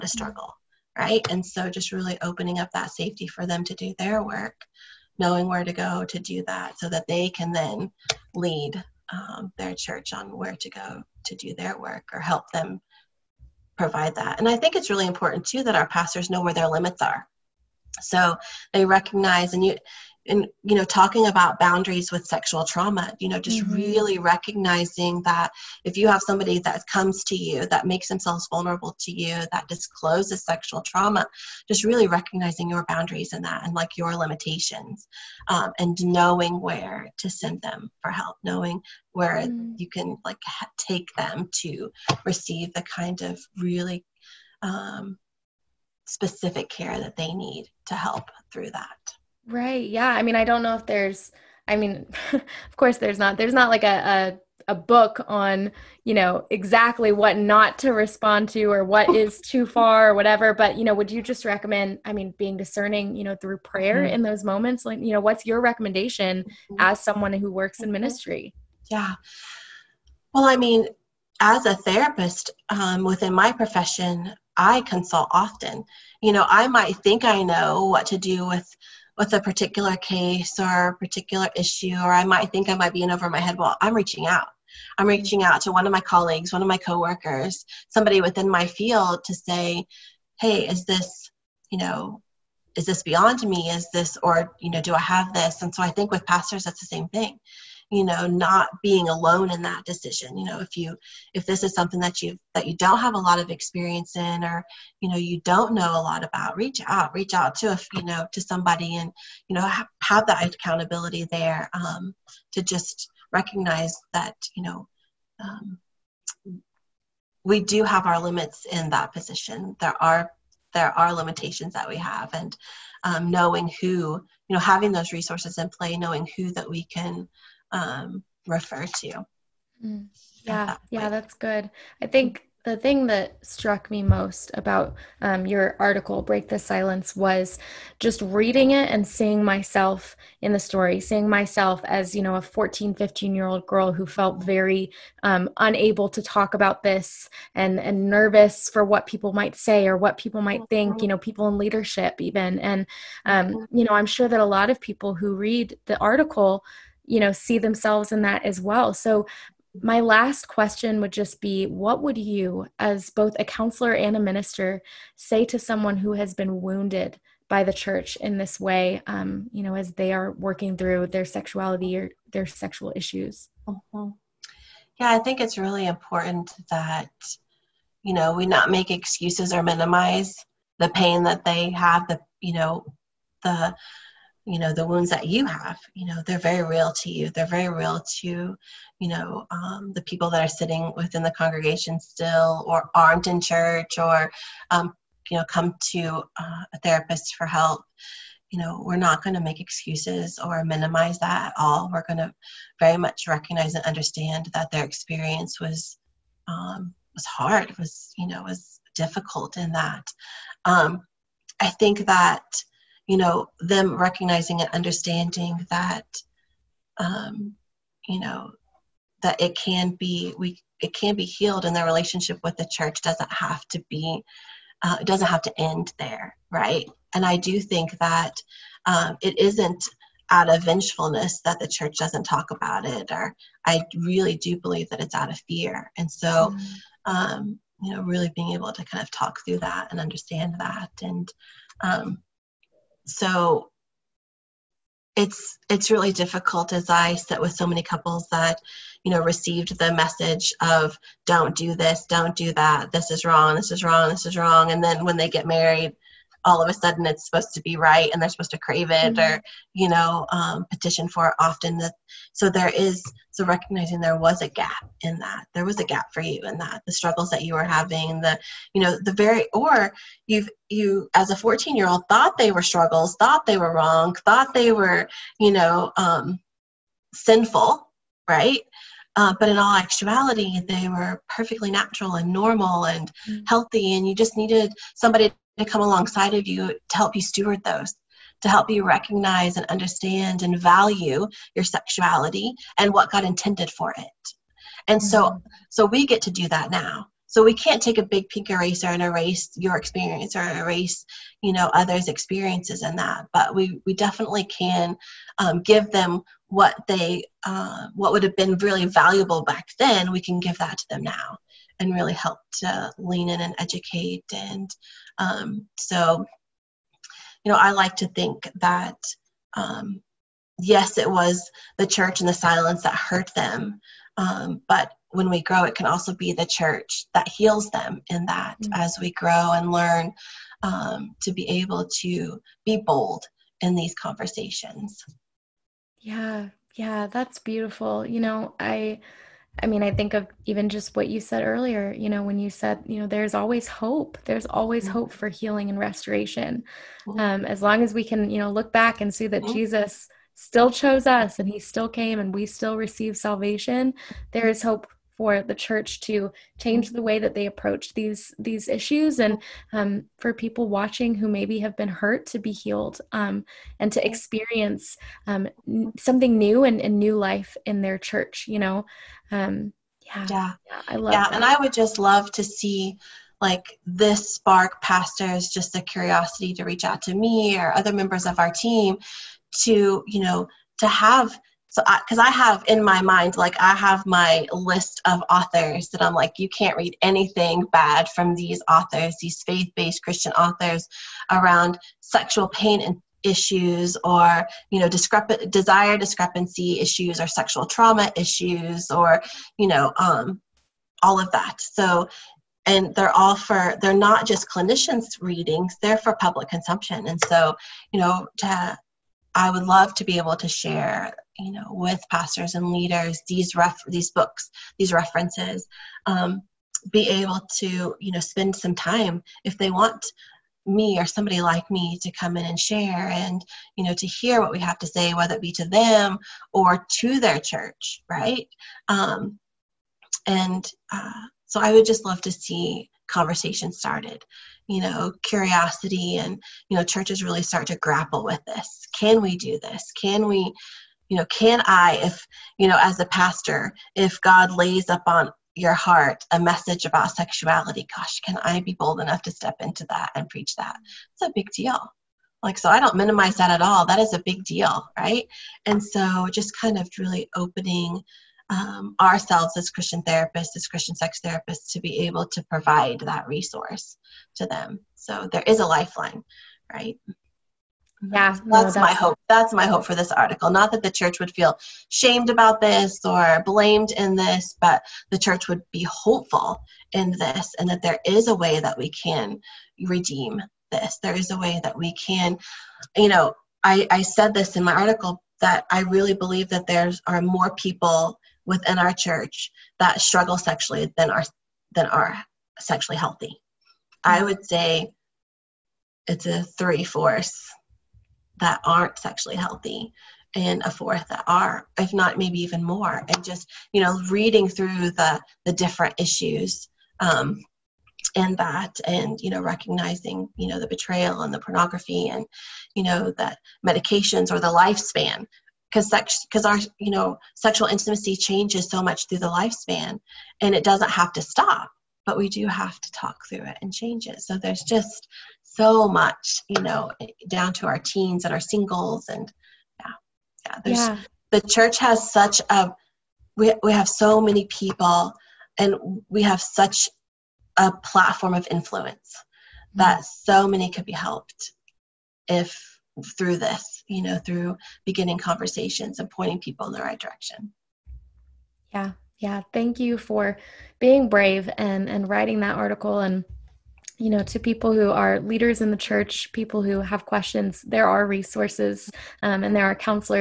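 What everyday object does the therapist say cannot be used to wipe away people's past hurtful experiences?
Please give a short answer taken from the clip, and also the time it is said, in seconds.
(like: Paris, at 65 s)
big pink eraser, at 298 s.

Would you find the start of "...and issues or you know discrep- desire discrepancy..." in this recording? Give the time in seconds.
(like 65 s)
392 s.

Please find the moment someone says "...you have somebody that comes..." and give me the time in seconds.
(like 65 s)
25 s.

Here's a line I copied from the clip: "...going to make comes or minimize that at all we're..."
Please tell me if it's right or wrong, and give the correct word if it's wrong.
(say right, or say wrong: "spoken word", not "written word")
wrong: "excuses", not "comes".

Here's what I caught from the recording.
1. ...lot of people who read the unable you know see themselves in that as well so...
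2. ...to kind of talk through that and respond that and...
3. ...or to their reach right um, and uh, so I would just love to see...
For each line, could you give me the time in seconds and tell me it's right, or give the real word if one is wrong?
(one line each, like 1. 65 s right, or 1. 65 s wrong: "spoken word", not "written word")
1. 154 s wrong: "article", not "unable"
2. 238 s wrong: "understand", not "respond"
3. 426 s wrong: "church", not "reach".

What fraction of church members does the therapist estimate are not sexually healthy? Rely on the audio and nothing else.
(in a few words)
three fourths.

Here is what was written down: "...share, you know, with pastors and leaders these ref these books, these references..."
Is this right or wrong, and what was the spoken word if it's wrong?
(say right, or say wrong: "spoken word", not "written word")
right.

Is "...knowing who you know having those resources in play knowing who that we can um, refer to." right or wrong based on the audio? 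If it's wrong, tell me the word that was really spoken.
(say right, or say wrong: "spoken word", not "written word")
right.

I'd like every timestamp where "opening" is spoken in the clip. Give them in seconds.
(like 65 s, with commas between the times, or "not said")
2 s, 457 s.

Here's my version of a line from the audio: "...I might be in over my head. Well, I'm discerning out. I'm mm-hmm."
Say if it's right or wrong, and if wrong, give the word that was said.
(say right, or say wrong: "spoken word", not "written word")
wrong: "reaching", not "discerning".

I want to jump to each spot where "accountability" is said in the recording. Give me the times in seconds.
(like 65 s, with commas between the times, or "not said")
110 s.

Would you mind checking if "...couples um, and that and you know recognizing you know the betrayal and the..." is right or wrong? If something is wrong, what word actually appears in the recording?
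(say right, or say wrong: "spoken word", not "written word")
wrong: "issues", not "couples".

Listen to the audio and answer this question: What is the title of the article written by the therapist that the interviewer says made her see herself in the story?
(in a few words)
Break the Silence.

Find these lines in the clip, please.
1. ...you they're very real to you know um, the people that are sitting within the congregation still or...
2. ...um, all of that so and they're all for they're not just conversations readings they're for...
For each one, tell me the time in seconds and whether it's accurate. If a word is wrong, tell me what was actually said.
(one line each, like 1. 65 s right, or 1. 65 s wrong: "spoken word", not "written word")
1. 187 s right
2. 399 s wrong: "clinicians", not "conversations".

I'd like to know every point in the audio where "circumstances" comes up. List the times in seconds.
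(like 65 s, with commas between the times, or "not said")
not said.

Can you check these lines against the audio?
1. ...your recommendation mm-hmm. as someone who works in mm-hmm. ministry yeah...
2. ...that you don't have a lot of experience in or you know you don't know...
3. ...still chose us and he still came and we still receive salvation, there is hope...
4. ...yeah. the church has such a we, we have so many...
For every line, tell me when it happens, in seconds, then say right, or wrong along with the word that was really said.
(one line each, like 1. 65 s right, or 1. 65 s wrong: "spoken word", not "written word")
1. 65 s right
2. 102 s right
3. 350 s right
4. 530 s right.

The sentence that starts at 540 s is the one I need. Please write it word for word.
so many could be helped if through this, you know, through beginning conversations and pointing people in the right direction.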